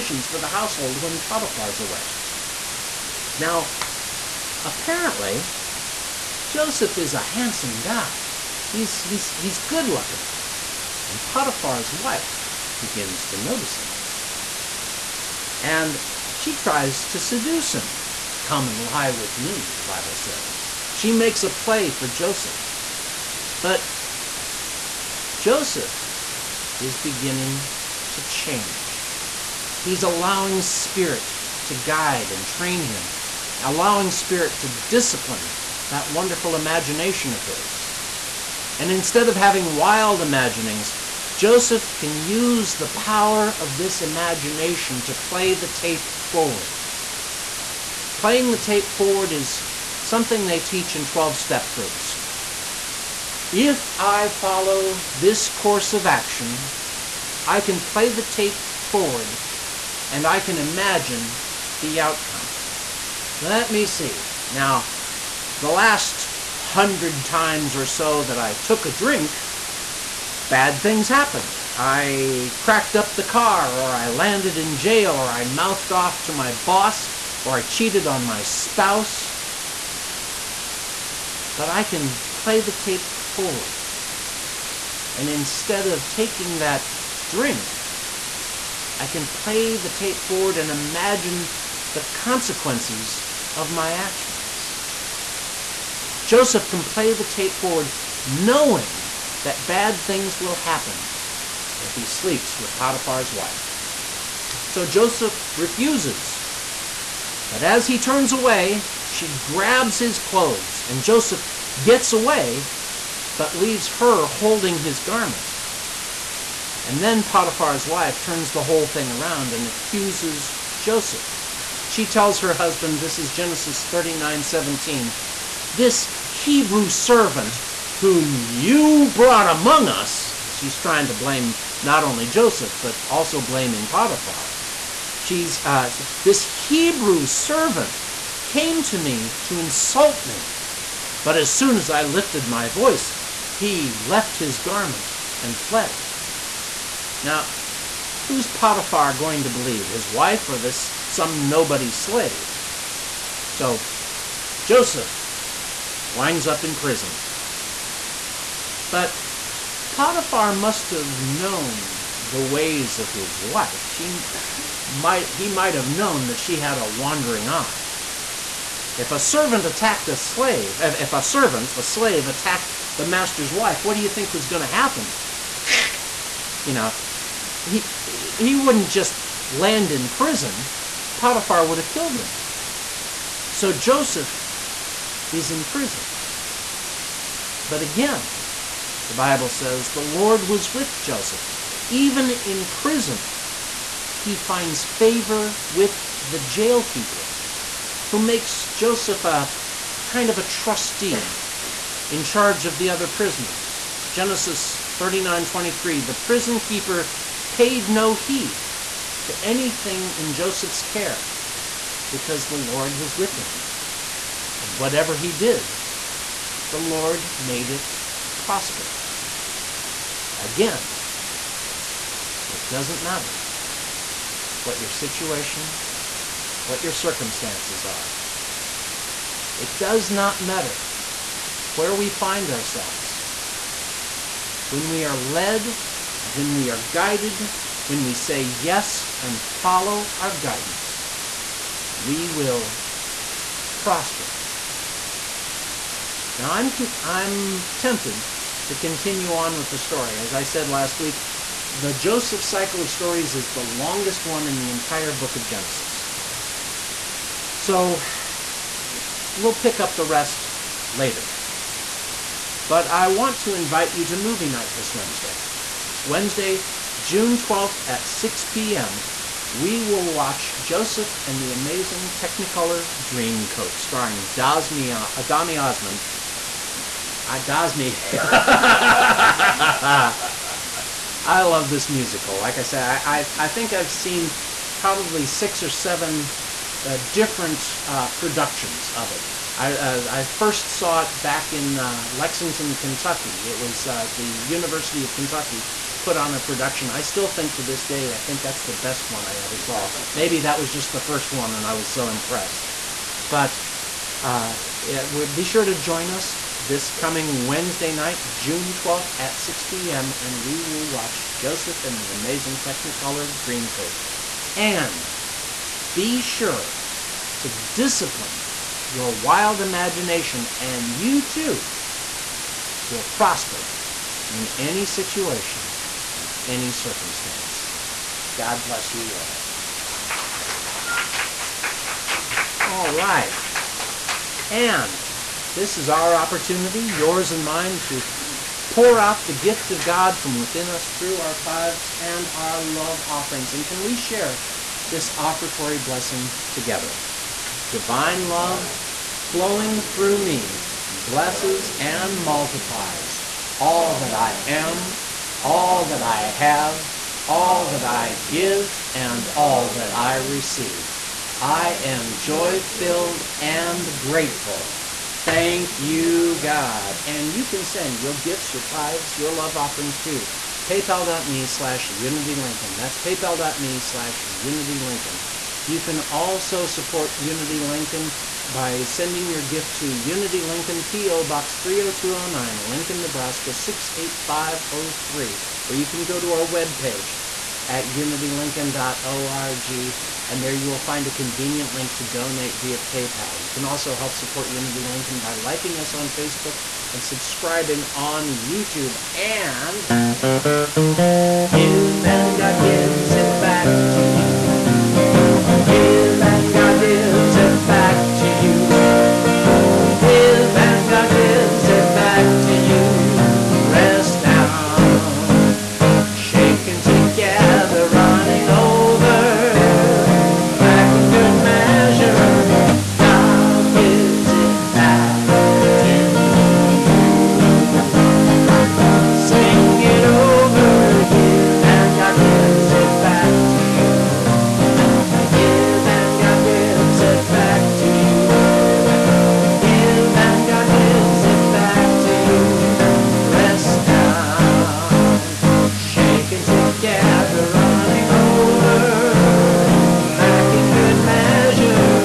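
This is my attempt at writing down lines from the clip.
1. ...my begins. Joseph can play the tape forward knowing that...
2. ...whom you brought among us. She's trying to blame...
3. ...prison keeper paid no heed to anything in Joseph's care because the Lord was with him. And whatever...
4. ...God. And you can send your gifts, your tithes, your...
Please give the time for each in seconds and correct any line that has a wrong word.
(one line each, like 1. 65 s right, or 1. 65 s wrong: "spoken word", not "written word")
1. 93 s wrong: "actions", not "begins"
2. 127 s right
3. 206 s right
4. 366 s right.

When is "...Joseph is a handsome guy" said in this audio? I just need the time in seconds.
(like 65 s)
6 s.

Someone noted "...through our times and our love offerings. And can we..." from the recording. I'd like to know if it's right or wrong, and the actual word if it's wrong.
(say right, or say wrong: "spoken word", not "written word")
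wrong: "tithes", not "times".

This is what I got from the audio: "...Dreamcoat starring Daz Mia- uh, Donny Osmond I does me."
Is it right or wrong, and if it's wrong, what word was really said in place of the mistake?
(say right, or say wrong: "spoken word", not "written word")
right.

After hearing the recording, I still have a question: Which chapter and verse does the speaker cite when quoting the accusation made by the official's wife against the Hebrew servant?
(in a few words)
Genesis 39:17.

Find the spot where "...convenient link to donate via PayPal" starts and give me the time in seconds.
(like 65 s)
391 s.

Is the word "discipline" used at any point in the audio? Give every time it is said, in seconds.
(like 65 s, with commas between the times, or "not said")
34 s, 317 s.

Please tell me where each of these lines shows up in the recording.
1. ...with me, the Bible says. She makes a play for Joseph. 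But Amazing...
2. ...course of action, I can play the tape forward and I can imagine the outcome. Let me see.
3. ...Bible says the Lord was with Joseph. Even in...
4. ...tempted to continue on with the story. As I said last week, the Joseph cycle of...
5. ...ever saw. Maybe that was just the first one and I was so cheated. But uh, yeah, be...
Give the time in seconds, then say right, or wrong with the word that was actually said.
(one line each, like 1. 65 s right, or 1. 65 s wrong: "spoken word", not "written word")
1. 19 s wrong: "Joseph", not "Amazing"
2. 55 s right
3. 189 s right
4. 247 s right
5. 299 s wrong: "impressed", not "cheated".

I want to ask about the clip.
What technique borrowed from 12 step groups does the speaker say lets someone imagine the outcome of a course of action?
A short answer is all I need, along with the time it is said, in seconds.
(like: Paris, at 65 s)
Playing the tape forward, at 48 s.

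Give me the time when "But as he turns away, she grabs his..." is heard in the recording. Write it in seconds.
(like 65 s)
107 s.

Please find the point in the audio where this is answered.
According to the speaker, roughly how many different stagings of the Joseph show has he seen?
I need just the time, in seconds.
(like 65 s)
285 s.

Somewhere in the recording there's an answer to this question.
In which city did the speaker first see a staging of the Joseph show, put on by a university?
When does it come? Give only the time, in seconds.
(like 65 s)
292 s.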